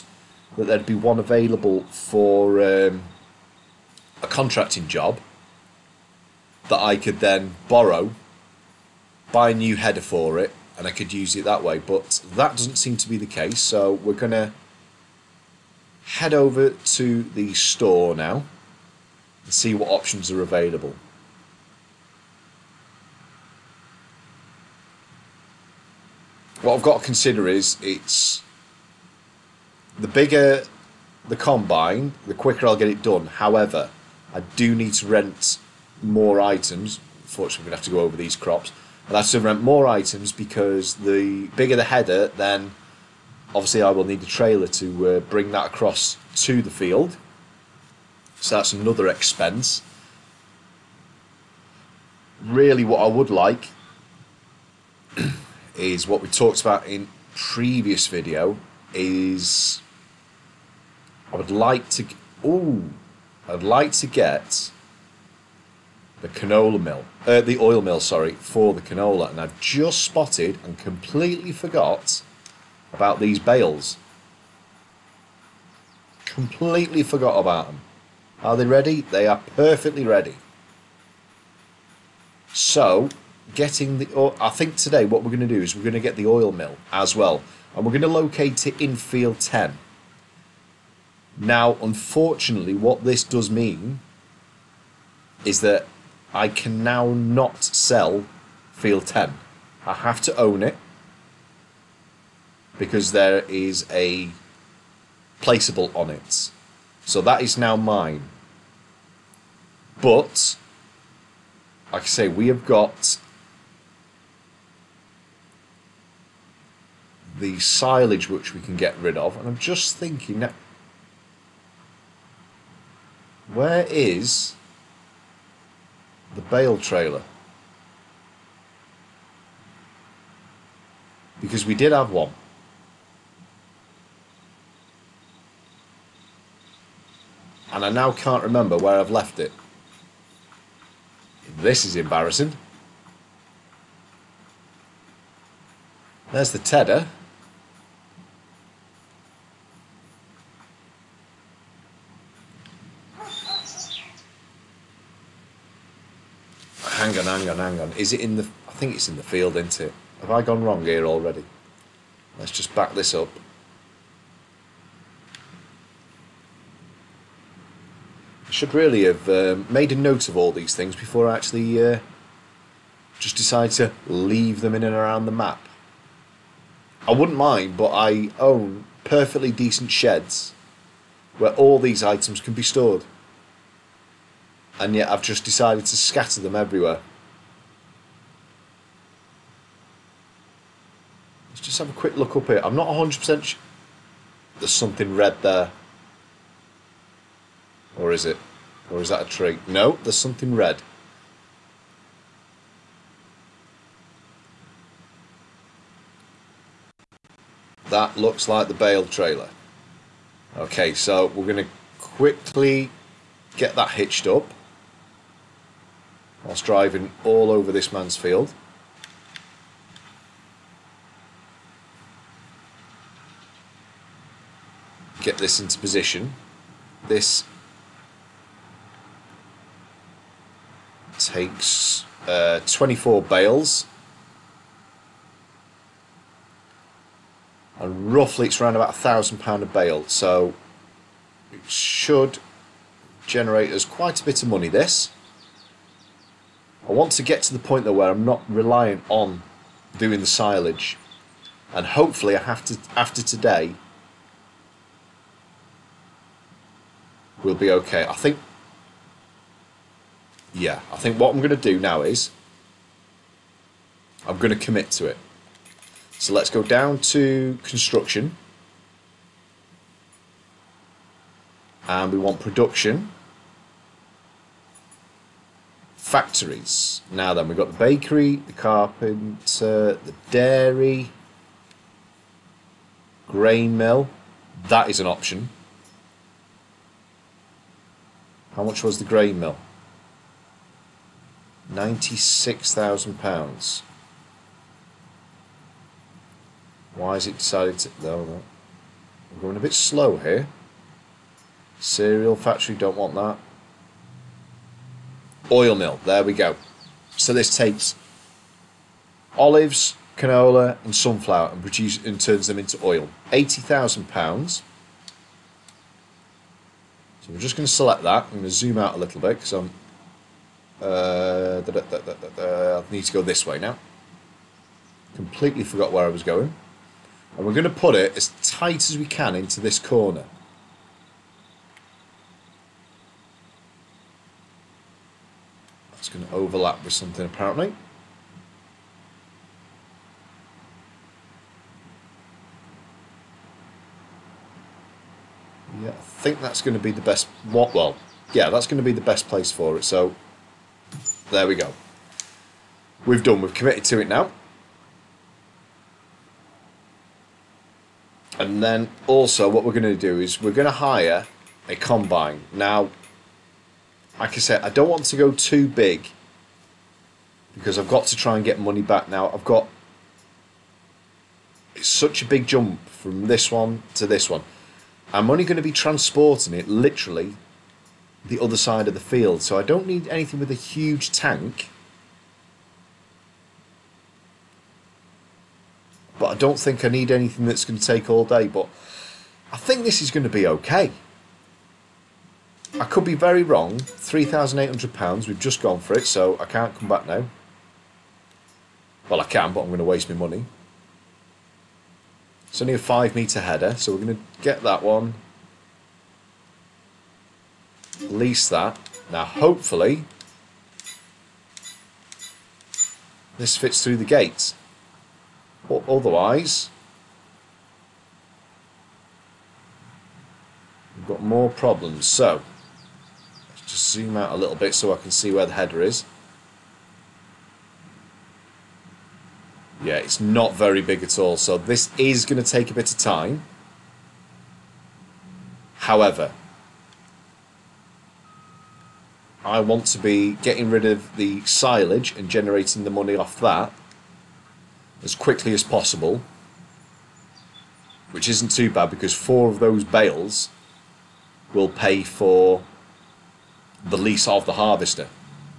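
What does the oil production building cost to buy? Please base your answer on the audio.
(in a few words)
£80,000.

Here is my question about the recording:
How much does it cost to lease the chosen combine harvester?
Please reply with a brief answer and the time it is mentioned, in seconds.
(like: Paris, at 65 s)
£3,800, at 393 s.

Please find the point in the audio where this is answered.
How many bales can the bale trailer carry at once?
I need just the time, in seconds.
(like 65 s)
232 s.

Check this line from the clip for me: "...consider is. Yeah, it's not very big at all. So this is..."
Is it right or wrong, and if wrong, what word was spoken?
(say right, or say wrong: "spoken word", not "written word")
wrong: "header", not "consider".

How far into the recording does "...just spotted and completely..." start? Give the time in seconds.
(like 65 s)
69 s.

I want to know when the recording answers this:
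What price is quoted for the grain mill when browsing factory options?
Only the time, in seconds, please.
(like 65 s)
291 s.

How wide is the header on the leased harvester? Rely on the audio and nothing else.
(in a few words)
5 metres.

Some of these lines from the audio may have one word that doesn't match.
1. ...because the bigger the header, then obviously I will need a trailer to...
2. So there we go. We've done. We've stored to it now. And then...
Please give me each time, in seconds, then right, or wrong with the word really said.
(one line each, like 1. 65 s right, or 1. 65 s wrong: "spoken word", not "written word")
1. 40 s right
2. 349 s wrong: "committed", not "stored".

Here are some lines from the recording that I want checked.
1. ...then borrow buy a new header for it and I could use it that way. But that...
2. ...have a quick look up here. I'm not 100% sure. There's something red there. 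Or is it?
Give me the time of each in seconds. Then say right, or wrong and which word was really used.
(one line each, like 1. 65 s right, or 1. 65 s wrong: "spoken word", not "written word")
1. 7 s right
2. 191 s right.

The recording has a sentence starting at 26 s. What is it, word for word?
What I've got to consider is it's the bigger the combine, the quicker I'll get it done.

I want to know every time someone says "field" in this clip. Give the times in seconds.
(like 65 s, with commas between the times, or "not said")
46 s, 88 s, 98 s, 159 s, 218 s, 378 s.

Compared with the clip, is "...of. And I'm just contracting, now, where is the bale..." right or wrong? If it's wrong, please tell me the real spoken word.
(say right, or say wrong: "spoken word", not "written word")
wrong: "thinking", not "contracting".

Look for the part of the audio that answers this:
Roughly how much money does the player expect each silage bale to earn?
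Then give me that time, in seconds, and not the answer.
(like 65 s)
238 s.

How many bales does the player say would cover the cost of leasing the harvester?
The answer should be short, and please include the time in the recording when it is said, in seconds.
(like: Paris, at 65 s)
4, at 449 s.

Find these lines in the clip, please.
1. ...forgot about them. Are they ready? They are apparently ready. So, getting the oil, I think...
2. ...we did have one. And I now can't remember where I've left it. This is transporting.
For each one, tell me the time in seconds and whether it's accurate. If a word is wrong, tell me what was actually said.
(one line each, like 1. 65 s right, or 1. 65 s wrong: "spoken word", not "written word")
1. 77 s wrong: "perfectly", not "apparently"
2. 131 s wrong: "embarrassing", not "transporting".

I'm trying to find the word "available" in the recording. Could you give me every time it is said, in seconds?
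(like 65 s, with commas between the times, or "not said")
1 s, 20 s.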